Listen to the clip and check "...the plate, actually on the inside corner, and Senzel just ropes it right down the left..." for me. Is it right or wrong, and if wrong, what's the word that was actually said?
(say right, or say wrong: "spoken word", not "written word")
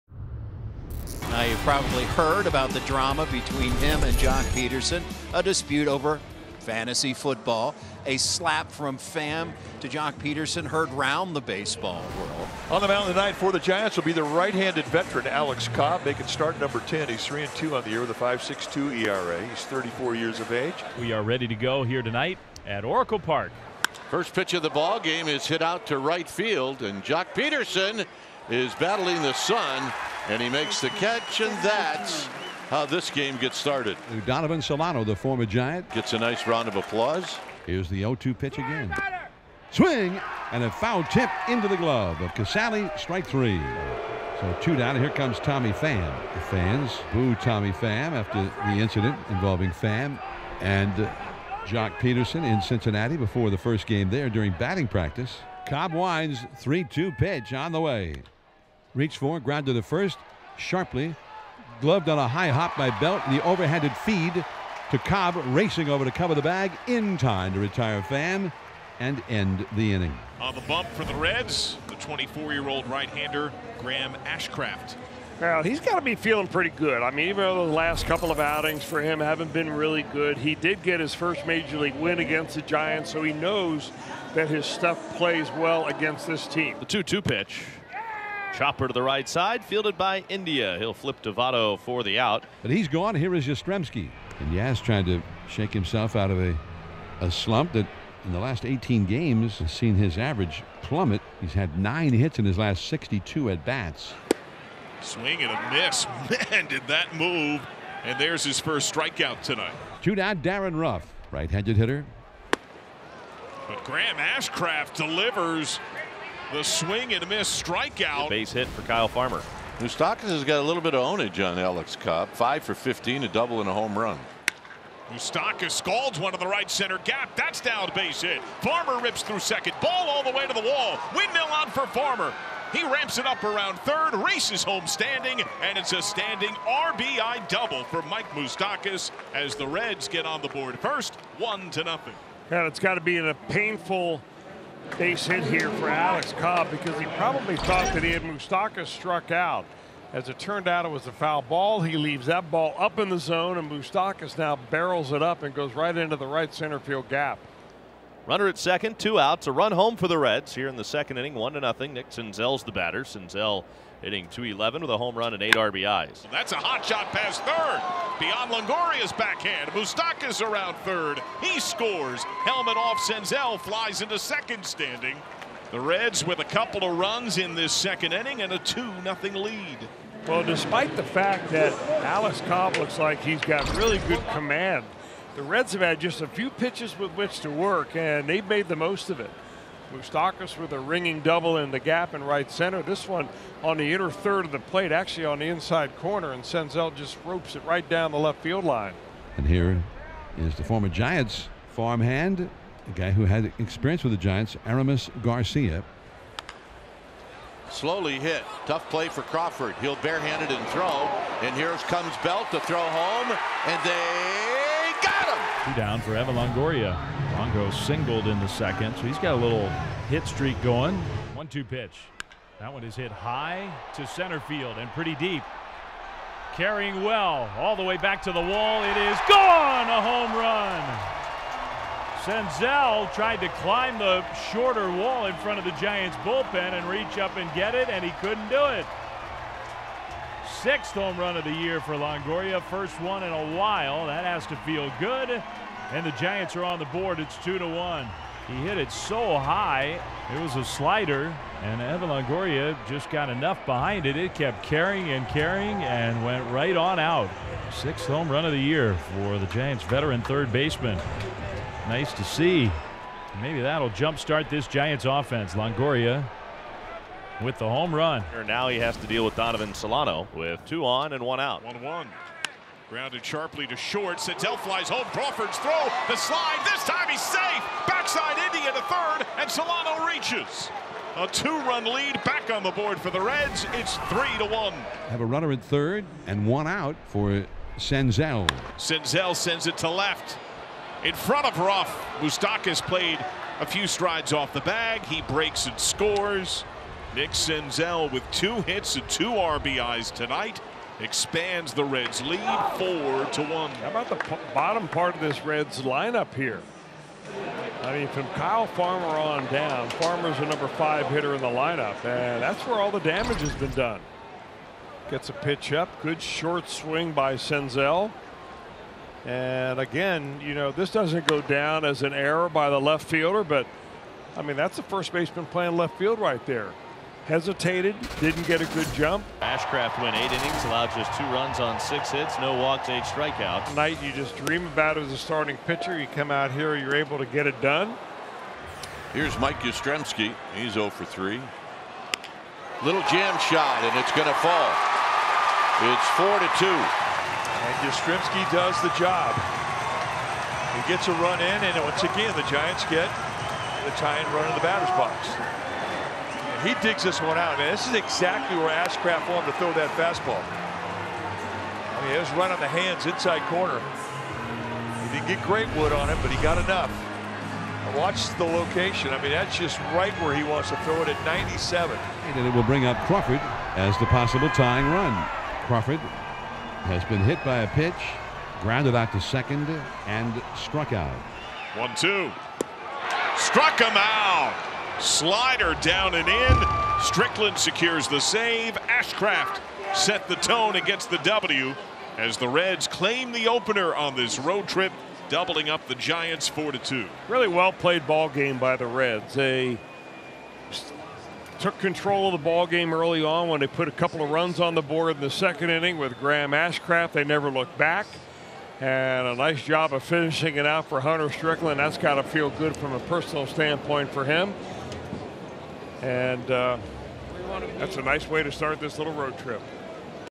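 right.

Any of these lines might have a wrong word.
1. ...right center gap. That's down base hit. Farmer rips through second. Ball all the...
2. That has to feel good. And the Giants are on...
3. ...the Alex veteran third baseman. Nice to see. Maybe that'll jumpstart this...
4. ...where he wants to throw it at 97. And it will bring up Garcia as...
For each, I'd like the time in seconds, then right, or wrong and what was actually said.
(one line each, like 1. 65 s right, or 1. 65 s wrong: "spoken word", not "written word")
1. 126 s right
2. 244 s right
3. 259 s wrong: "Giants", not "Alex"
4. 370 s wrong: "Crawford", not "Garcia".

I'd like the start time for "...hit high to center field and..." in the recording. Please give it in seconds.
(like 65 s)
222 s.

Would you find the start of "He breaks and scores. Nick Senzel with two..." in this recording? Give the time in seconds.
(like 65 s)
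295 s.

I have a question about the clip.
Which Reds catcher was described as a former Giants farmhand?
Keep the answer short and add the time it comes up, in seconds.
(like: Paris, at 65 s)
Aramis Garcia, at 204 s.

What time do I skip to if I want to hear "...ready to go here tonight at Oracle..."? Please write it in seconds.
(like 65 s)
21 s.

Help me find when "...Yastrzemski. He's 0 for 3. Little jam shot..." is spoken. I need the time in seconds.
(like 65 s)
339 s.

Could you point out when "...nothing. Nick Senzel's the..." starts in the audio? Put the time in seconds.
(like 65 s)
161 s.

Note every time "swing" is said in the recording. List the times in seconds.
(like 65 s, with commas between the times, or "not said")
39 s, 105 s, 116 s, 316 s.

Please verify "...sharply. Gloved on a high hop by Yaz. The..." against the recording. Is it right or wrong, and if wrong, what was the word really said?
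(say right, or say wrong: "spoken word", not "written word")
wrong: "Belt", not "Yaz".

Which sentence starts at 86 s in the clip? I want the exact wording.
The 2-2 pitch Chopper to the right side, fielded by India.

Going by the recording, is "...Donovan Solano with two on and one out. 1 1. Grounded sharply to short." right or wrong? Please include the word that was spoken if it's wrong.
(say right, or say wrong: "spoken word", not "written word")
right.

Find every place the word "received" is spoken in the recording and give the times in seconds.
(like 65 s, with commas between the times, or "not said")
not said.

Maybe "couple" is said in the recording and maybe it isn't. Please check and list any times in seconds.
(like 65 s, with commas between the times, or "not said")
78 s, 176 s, 403 s.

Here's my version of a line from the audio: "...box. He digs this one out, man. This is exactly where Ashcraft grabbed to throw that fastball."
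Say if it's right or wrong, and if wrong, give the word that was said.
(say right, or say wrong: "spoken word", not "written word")
wrong: "wanted", not "grabbed".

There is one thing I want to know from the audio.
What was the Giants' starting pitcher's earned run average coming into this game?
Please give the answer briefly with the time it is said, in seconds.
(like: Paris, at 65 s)
5.62, at 18 s.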